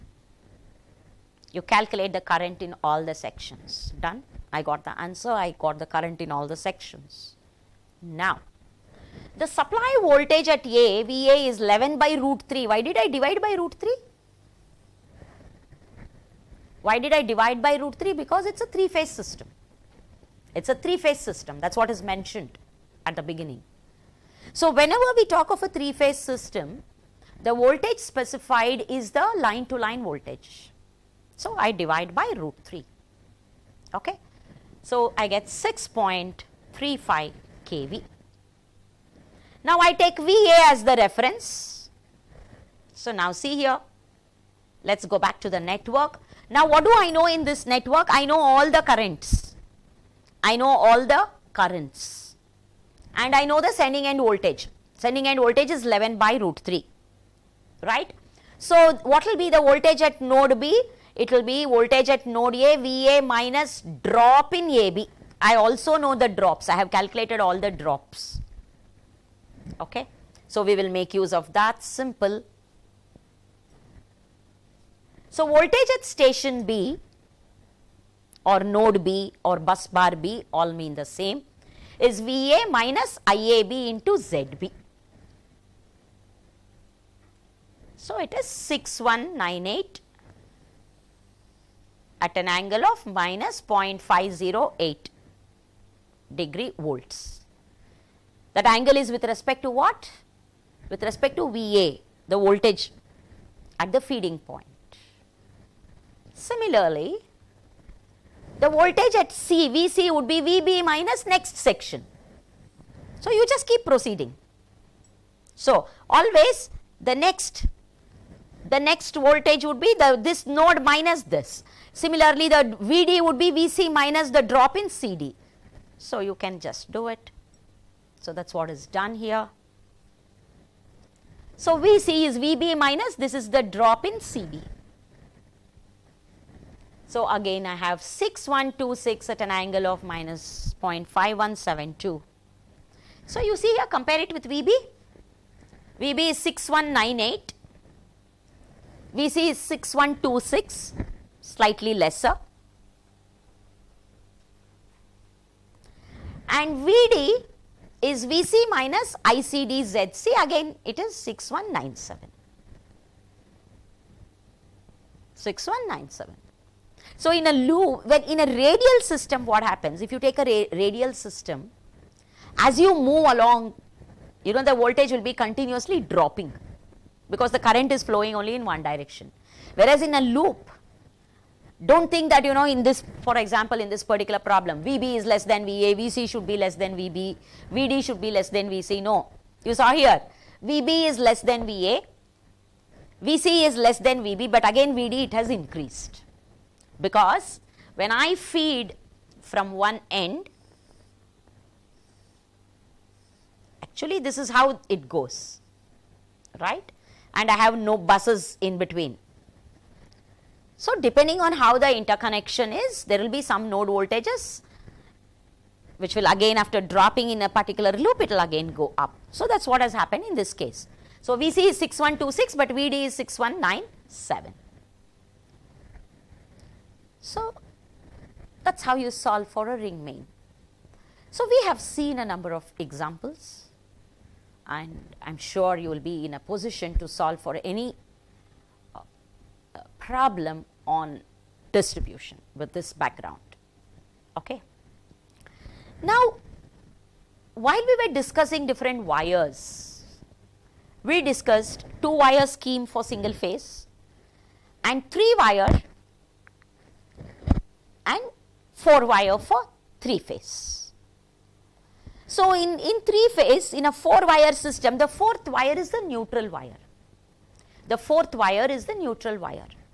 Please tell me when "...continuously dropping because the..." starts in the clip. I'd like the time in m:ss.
2:55.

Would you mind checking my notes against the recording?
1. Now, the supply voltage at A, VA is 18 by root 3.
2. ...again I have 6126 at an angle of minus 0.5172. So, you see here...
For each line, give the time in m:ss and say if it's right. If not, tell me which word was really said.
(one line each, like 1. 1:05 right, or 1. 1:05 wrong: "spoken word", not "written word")
1. 0:08 wrong: "11", not "18"
2. 2:17 right.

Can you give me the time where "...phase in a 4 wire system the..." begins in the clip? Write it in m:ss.
4:23.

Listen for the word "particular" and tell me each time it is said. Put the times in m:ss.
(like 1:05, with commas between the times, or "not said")
3:04, 3:37.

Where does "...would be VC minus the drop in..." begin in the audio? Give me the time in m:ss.
2:03.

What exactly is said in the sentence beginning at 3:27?
And I have no buses in between.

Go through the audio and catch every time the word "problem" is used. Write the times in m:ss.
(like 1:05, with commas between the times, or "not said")
3:04, 3:59.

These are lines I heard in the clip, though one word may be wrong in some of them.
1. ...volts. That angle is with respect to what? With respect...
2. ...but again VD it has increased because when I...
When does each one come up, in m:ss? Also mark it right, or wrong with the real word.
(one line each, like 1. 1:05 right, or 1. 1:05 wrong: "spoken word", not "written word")
1. 1:36 right
2. 3:14 right.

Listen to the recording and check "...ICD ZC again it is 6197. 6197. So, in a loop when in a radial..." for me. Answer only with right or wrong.
right.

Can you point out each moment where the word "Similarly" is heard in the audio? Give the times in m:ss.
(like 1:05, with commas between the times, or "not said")
1:46, 2:01.